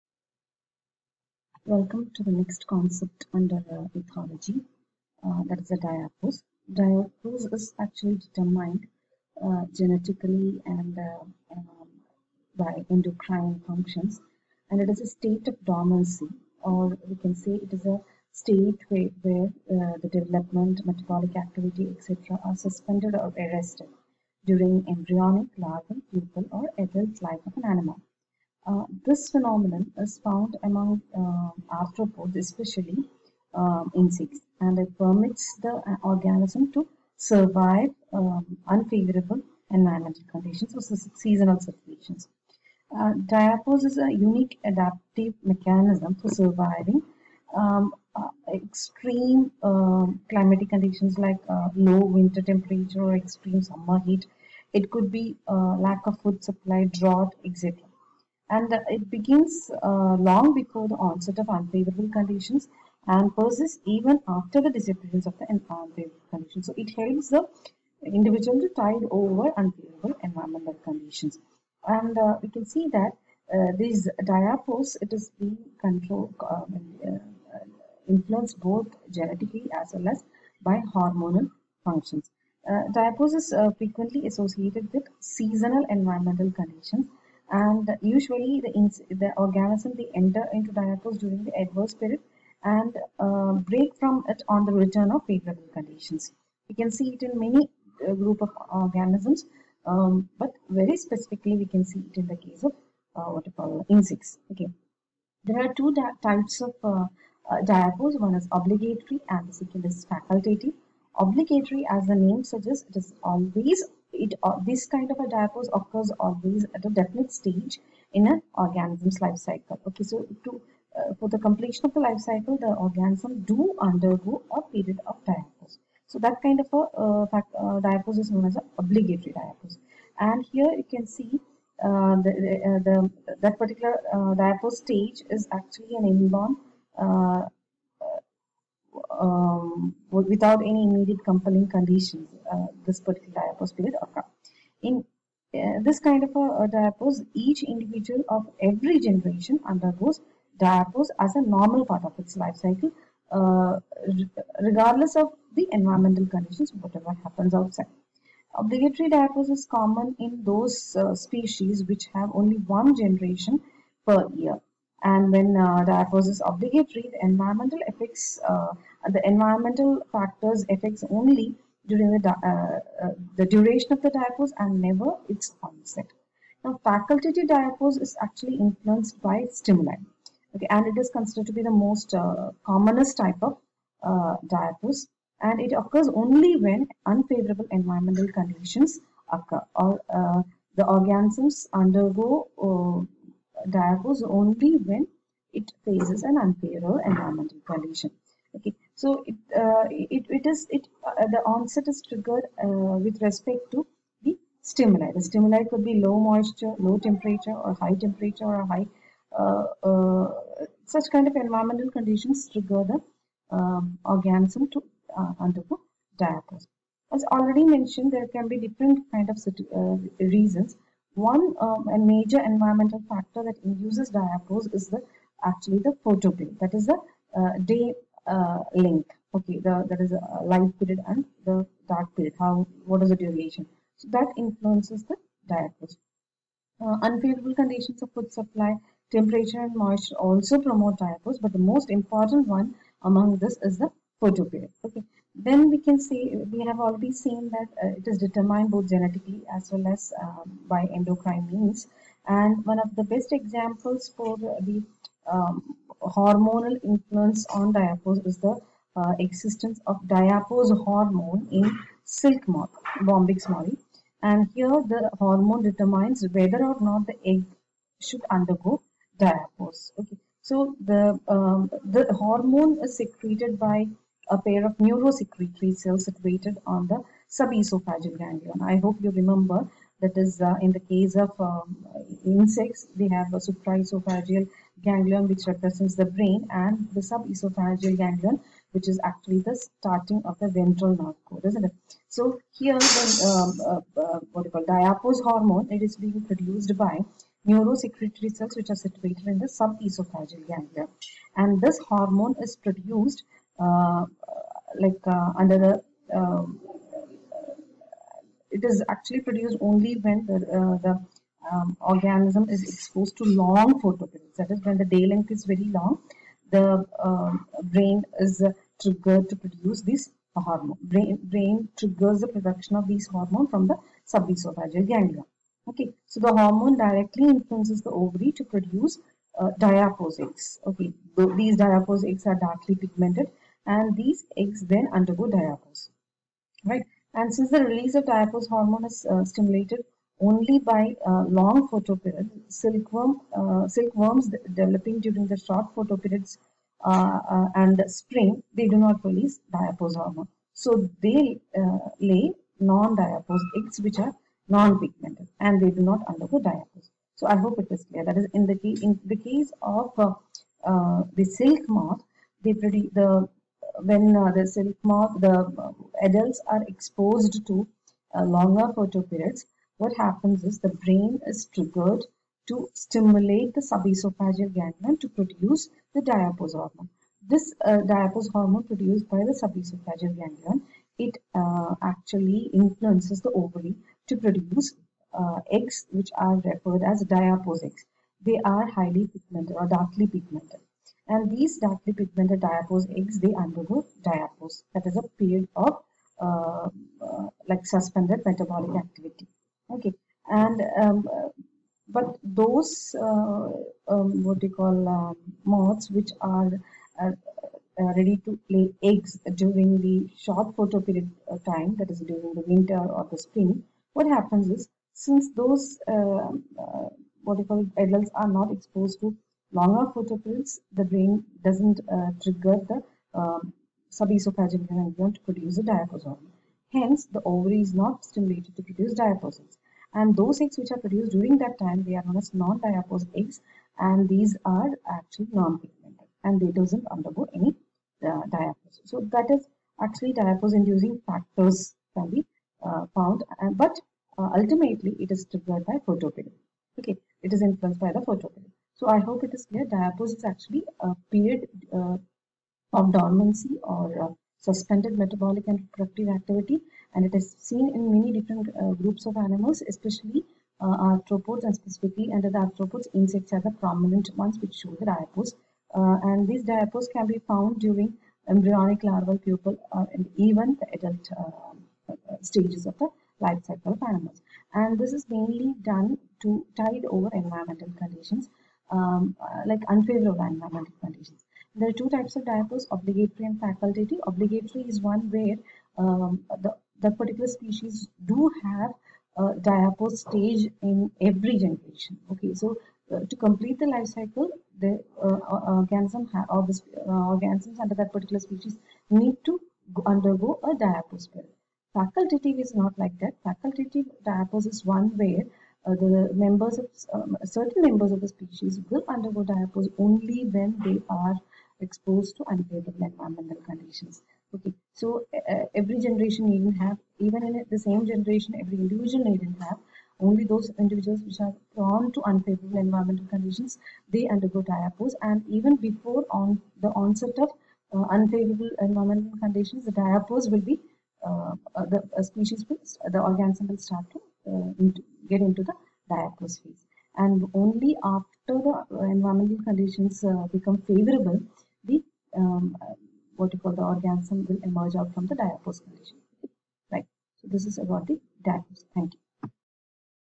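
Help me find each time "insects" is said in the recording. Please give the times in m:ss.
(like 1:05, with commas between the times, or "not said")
0:33, 1:43, 4:42, 7:42.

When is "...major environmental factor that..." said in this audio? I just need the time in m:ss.
3:41.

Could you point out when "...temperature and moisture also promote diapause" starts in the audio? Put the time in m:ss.
3:59.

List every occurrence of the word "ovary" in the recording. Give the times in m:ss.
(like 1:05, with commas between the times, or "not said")
5:27, 6:23, 7:07.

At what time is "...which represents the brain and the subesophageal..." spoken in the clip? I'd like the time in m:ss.
4:45.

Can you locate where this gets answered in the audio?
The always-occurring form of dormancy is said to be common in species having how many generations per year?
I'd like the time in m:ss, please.
2:42.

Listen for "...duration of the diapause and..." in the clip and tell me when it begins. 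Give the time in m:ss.
2:53.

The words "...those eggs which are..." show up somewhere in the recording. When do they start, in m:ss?
7:10.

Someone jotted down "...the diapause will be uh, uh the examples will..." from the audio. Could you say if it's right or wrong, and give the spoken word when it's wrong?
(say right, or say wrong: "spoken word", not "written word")
wrong: "species", not "examples".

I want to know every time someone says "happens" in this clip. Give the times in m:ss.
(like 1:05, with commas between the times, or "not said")
2:37, 6:09, 6:54.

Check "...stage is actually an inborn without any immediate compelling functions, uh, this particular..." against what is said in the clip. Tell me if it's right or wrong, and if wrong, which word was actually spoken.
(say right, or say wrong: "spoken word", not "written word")
wrong: "conditions", not "functions".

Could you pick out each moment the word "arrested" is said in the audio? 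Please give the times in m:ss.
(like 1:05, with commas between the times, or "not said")
0:23.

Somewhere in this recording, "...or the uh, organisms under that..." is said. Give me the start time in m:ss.
8:16.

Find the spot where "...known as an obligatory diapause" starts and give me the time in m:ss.
2:08.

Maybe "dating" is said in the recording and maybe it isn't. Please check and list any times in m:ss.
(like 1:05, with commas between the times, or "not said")
not said.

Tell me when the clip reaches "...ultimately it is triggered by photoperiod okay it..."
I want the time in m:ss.
7:24.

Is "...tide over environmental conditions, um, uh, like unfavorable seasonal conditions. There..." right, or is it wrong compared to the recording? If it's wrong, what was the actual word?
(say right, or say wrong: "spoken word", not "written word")
wrong: "environmental", not "seasonal".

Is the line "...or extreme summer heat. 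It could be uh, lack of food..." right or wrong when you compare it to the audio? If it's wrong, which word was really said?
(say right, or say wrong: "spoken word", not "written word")
right.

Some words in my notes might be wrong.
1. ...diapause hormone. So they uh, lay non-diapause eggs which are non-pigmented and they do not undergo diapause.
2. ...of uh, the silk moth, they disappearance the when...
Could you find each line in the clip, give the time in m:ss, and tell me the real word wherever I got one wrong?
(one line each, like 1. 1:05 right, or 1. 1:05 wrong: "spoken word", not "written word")
1. 5:49 right
2. 5:59 wrong: "produce", not "disappearance".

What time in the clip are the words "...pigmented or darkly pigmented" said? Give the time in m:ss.
6:29.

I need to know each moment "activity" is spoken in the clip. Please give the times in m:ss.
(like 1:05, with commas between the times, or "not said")
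0:21, 6:38, 7:36.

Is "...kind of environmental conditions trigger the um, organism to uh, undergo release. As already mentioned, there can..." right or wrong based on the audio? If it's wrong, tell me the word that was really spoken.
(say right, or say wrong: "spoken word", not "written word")
wrong: "diapause", not "release".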